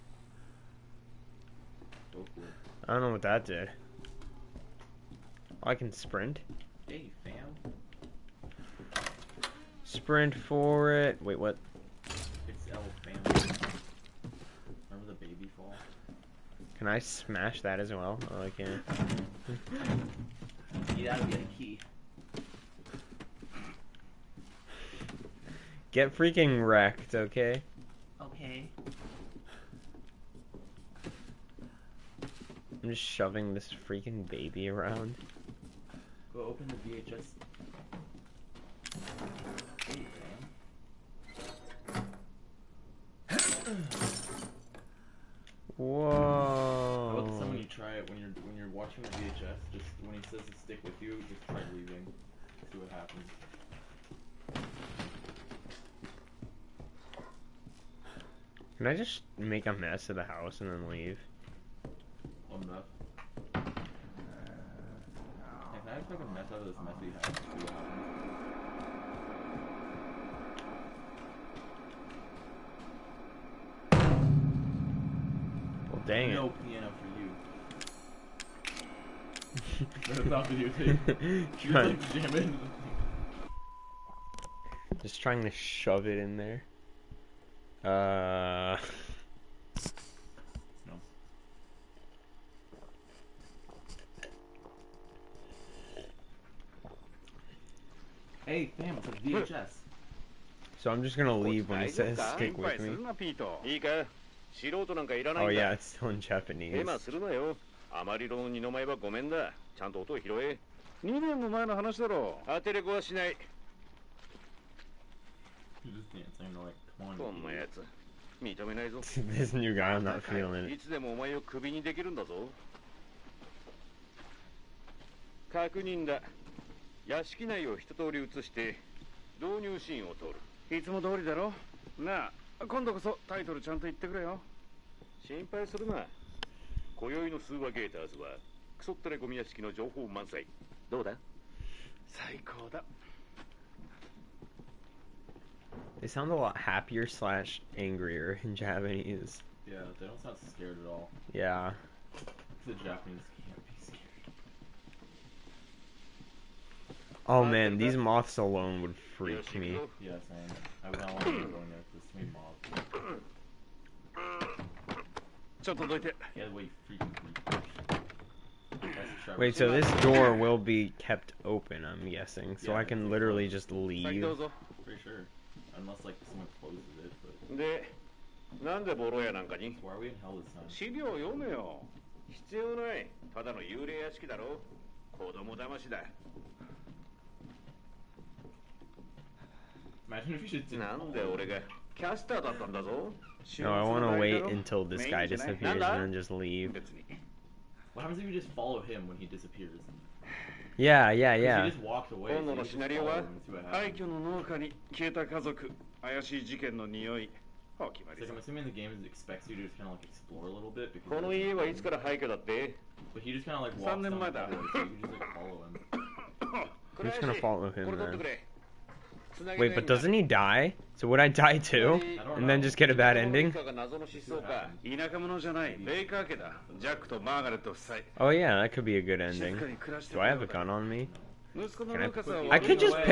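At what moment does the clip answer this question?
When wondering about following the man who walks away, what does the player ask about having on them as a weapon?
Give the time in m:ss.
3:50.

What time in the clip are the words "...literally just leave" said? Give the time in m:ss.
2:53.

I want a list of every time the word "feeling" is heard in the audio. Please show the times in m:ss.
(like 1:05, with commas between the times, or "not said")
2:00.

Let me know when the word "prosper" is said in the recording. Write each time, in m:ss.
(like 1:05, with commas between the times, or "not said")
not said.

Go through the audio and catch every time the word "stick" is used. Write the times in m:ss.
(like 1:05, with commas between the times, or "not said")
0:50, 1:42.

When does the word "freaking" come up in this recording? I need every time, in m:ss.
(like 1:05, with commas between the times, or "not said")
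0:26, 0:33, 2:46.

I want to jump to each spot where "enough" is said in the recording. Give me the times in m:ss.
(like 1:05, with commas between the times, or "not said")
1:02.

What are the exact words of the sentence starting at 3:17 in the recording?
What happens if you just follow him when he disappears?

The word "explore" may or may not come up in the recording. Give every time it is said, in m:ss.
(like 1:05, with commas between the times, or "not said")
3:30.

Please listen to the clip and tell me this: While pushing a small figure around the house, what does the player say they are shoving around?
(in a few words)
Baby.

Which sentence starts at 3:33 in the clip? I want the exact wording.
But he just kind of like walks down the so you just like follow him.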